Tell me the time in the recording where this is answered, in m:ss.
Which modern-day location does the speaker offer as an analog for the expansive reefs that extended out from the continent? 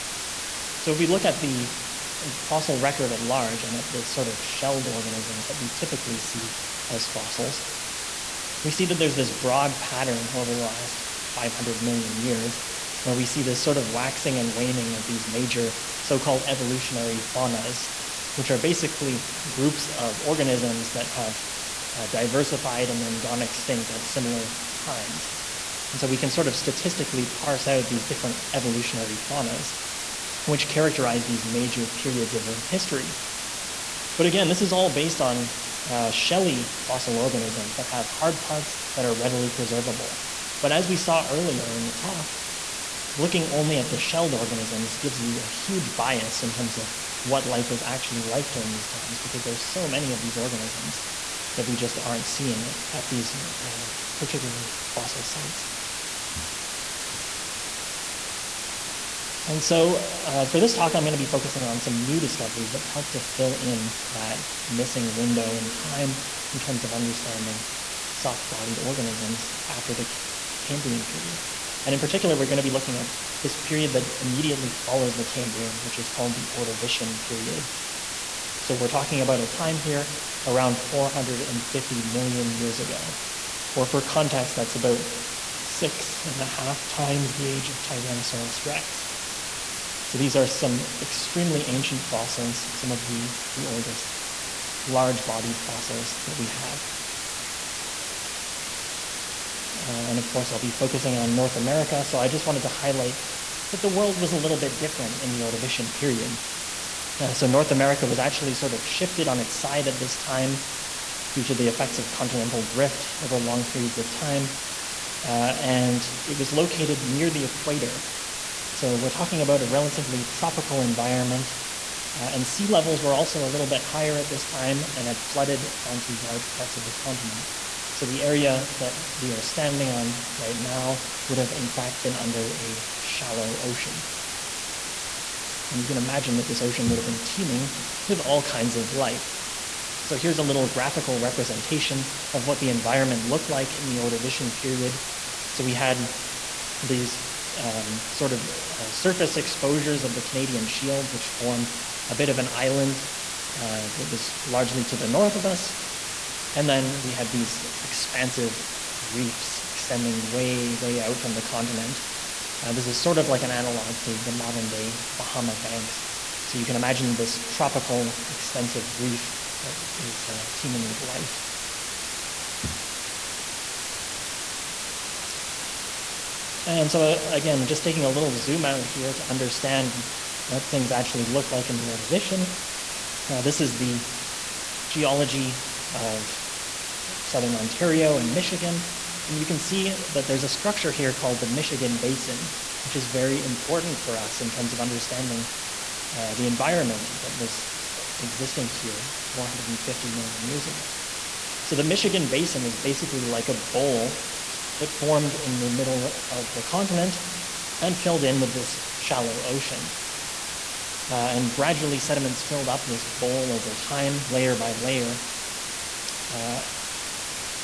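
2:45.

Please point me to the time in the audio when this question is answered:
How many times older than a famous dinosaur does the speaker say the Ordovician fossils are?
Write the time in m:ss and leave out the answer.
1:25.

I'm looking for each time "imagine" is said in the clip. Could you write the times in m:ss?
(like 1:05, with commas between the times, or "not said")
2:15, 2:46.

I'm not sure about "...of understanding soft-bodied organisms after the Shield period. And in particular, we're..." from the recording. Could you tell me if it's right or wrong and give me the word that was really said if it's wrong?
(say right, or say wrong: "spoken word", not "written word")
wrong: "Cambrian", not "Shield".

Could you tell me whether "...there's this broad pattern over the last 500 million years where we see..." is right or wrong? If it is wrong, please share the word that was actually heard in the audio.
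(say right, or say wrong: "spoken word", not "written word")
right.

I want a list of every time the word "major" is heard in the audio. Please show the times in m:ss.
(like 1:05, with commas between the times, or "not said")
0:15, 0:31.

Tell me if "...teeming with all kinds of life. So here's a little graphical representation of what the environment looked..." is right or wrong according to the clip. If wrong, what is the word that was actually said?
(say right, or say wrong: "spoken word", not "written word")
right.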